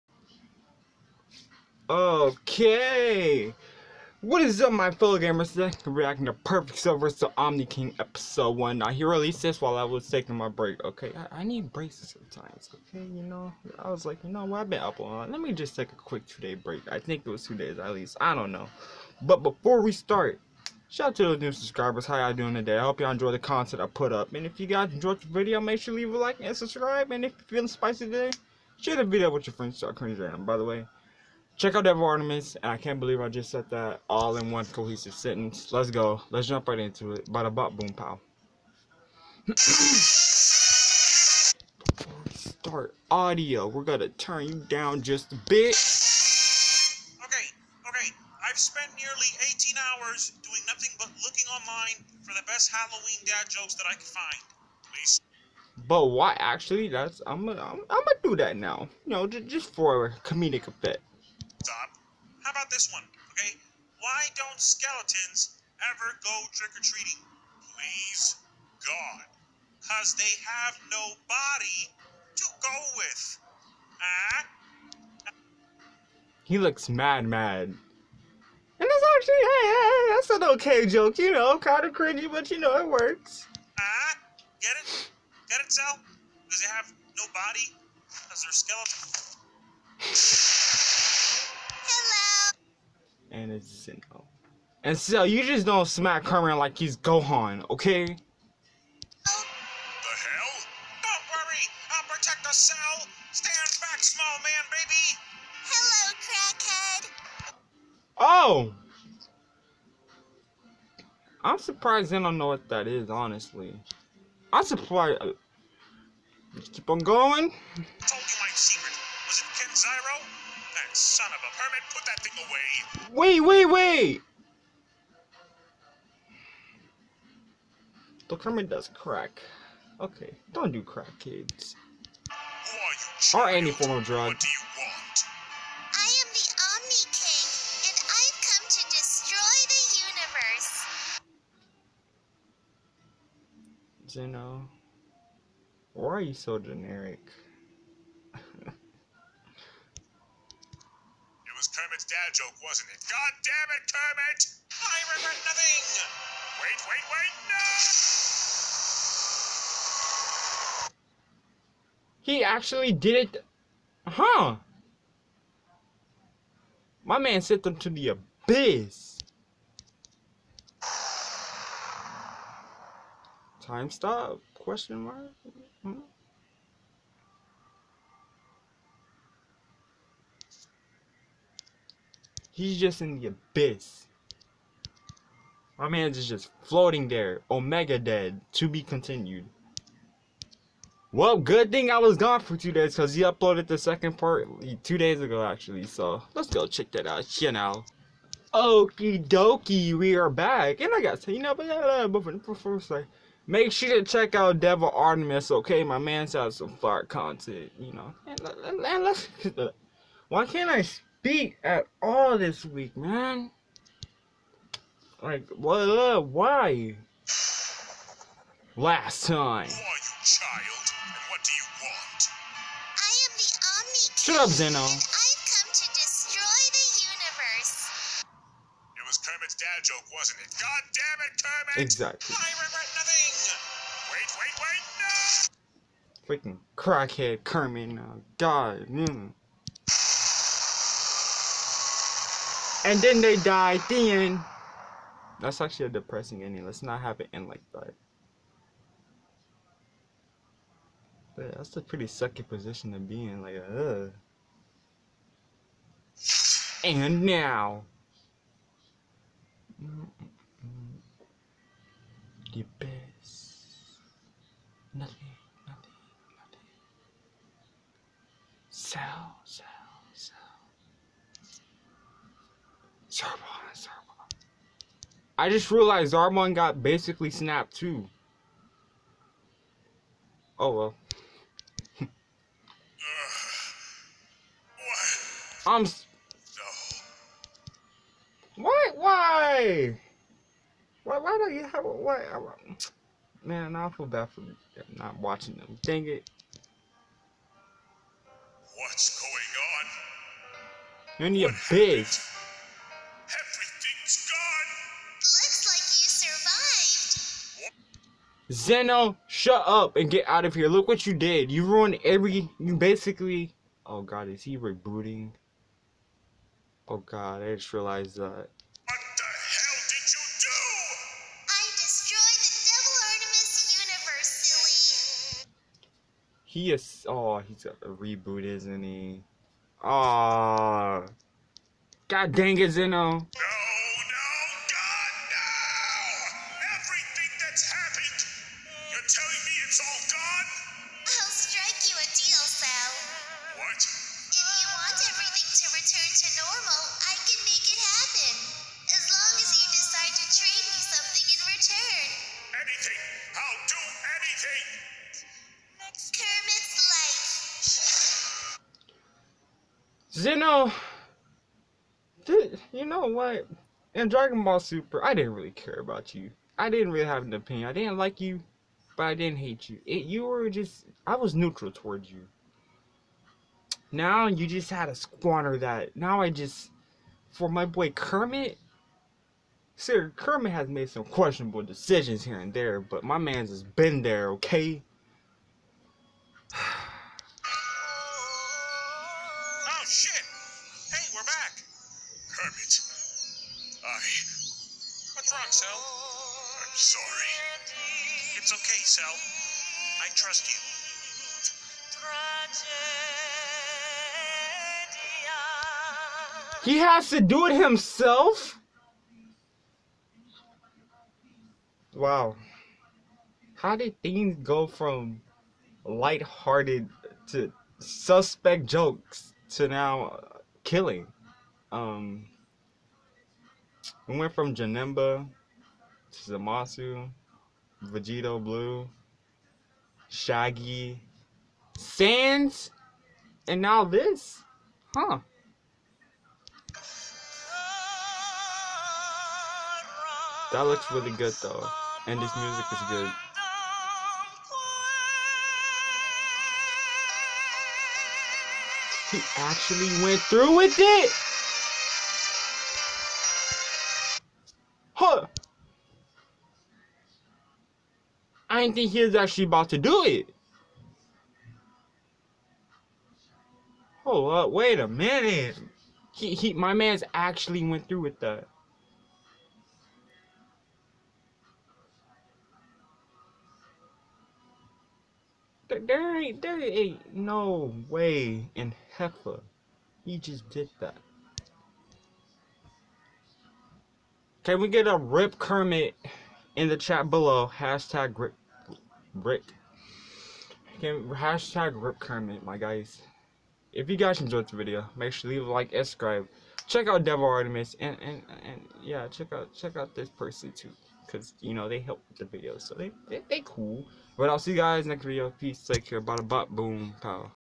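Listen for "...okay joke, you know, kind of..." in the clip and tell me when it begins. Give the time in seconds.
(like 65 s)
80 s.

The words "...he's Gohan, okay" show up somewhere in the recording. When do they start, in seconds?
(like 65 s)
96 s.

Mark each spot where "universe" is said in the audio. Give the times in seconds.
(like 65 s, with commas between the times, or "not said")
140 s, 227 s, 325 s.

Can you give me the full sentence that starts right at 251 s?
But that's a pretty sucky position to be in.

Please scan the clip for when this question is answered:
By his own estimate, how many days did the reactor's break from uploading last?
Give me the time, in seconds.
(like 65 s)
16 s.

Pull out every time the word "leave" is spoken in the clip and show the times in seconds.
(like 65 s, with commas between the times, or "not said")
26 s, 495 s.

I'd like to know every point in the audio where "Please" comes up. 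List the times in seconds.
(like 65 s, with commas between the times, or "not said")
54 s, 67 s.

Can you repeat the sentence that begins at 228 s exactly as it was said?
It was Kermit's dad joke, wasn't it?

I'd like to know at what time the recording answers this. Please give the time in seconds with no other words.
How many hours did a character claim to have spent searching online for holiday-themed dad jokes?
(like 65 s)
49 s.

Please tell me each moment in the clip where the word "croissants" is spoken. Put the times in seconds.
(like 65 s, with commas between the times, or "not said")
not said.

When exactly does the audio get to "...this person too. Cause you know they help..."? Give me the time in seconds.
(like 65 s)
499 s.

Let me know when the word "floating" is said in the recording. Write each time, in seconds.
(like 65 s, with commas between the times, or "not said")
186 s.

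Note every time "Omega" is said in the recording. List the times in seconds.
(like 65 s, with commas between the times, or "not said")
187 s.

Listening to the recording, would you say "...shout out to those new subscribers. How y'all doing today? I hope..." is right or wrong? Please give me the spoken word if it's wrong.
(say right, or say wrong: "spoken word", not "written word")
right.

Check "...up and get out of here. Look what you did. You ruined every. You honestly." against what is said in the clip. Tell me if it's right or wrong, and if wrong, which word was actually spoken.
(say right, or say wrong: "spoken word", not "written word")
wrong: "basically", not "honestly".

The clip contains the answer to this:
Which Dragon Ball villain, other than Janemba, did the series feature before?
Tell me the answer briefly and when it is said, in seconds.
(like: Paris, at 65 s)
Zamasu, at 426 s.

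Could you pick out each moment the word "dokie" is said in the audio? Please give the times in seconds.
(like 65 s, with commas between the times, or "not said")
199 s.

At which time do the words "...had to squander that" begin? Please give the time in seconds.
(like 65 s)
374 s.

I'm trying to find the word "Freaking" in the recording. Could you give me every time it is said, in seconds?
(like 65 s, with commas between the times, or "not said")
236 s.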